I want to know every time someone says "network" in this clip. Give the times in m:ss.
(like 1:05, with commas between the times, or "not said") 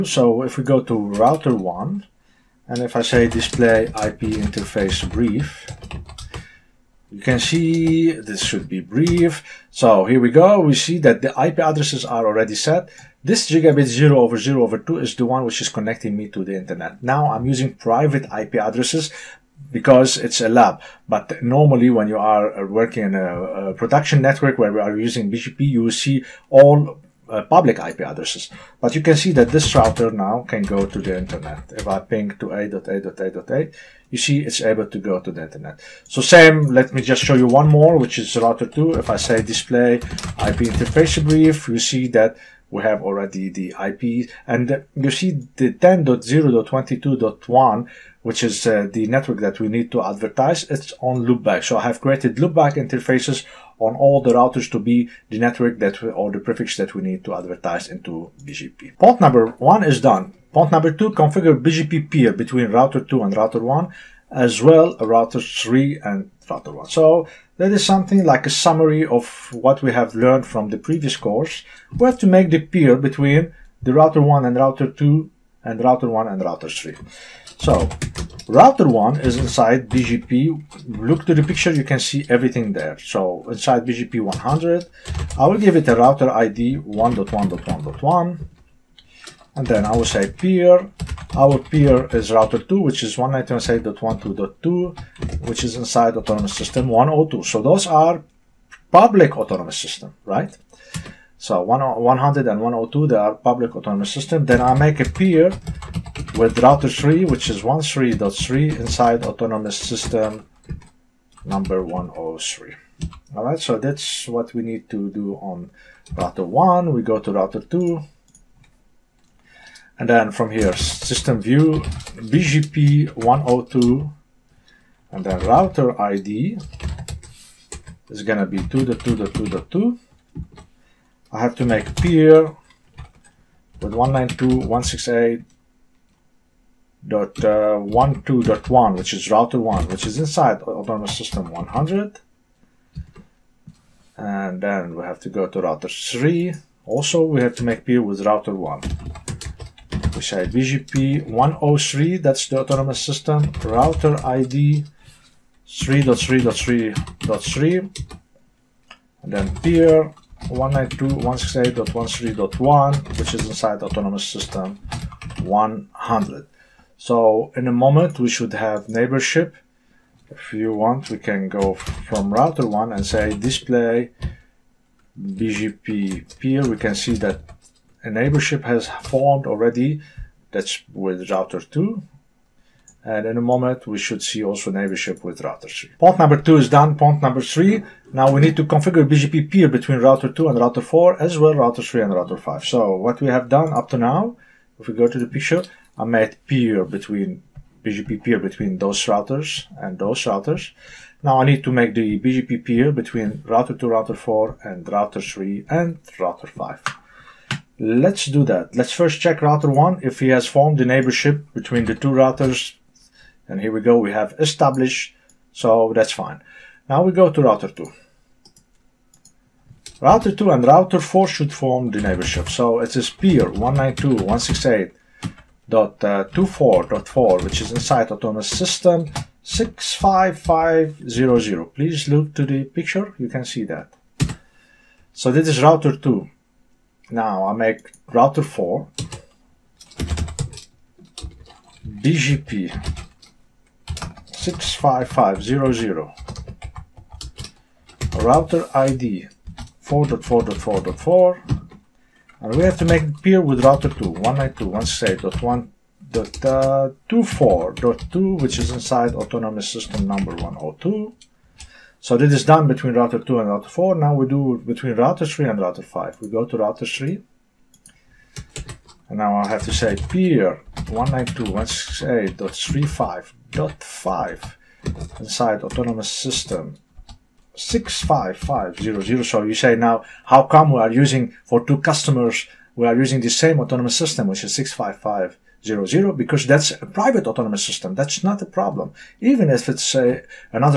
0:24, 0:49, 0:55.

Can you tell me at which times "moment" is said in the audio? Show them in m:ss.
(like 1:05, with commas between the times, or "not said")
2:47, 3:03.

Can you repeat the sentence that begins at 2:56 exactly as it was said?
We can see that a neighborship has formed already.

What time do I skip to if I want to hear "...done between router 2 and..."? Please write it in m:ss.
4:22.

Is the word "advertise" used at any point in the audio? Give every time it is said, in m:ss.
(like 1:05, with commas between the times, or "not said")
0:50, 0:57.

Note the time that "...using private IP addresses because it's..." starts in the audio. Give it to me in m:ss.
0:17.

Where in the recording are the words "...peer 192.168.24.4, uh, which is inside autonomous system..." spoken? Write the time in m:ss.
3:43.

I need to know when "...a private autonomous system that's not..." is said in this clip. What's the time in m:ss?
4:46.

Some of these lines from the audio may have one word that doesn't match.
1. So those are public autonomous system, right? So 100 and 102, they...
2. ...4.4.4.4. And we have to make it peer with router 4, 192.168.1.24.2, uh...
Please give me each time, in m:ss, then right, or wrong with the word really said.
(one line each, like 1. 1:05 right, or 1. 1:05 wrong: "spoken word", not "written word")
1. 1:37 right
2. 4:09 wrong: "2", not "4".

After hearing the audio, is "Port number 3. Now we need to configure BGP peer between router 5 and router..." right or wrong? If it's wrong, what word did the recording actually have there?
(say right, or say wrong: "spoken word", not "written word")
wrong: "2", not "5".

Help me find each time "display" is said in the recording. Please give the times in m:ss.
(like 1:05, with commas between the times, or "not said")
0:03, 0:39, 2:53.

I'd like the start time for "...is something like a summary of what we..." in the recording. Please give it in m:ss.
1:07.